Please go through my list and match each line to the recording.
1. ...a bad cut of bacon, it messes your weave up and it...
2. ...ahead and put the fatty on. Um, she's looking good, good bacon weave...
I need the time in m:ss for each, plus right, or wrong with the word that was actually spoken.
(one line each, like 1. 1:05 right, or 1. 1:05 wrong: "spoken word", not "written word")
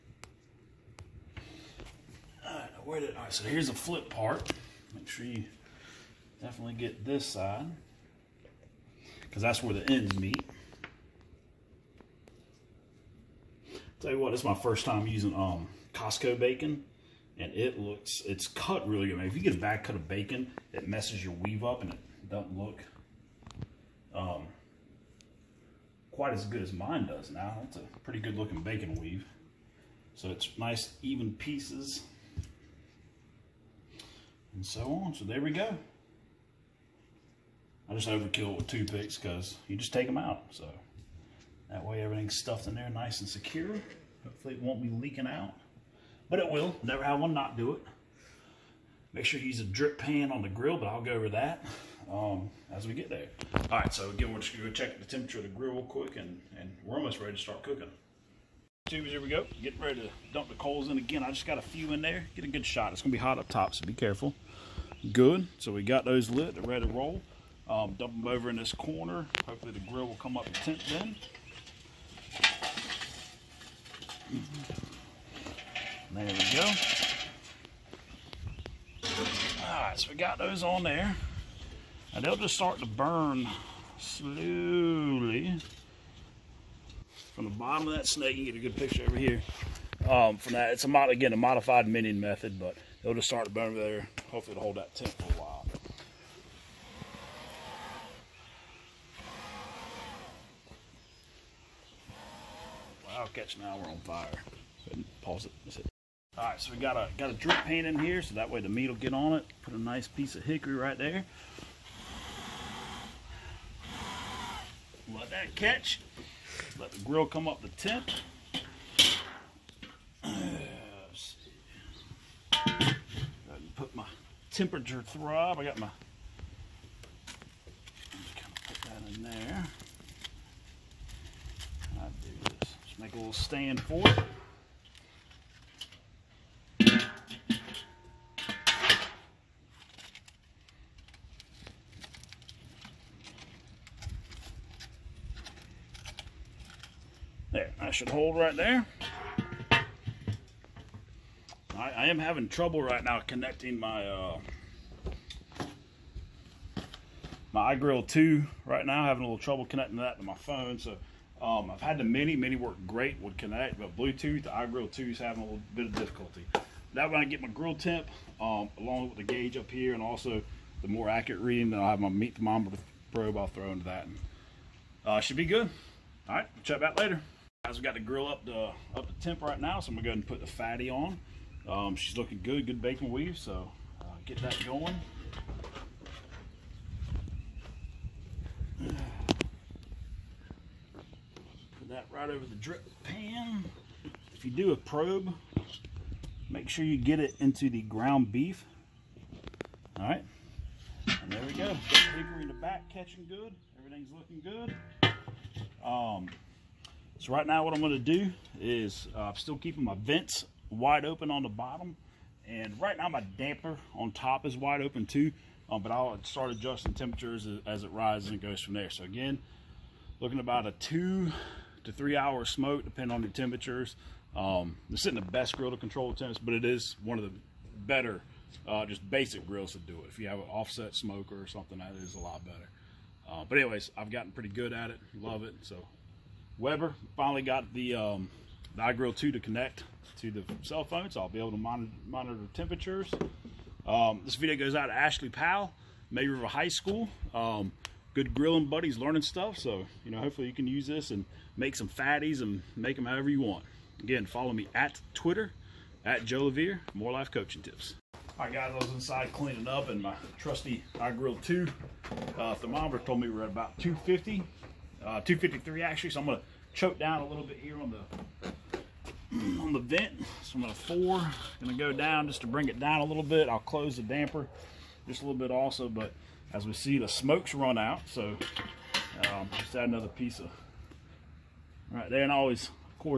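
1. 0:19 right
2. 3:00 right.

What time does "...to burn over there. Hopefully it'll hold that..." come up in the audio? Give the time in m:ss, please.
1:33.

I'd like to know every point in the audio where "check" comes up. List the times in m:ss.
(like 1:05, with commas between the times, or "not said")
0:54, 2:56.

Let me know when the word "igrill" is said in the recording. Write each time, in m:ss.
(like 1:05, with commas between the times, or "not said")
2:37, 2:44, 3:58.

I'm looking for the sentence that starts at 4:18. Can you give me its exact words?
All right, guys, I was inside cleaning up, and my trusty grill.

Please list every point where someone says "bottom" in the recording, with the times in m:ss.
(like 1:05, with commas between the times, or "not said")
1:27, 3:31.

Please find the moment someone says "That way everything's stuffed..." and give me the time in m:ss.
0:41.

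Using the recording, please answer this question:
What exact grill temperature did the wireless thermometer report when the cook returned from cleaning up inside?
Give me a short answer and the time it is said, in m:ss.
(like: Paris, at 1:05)
253, at 4:25.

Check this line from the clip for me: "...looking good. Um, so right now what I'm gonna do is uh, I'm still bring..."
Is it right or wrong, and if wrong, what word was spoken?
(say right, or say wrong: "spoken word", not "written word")
wrong: "keeping", not "bring".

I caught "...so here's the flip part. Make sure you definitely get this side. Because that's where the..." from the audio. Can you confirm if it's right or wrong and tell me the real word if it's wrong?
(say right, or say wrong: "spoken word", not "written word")
right.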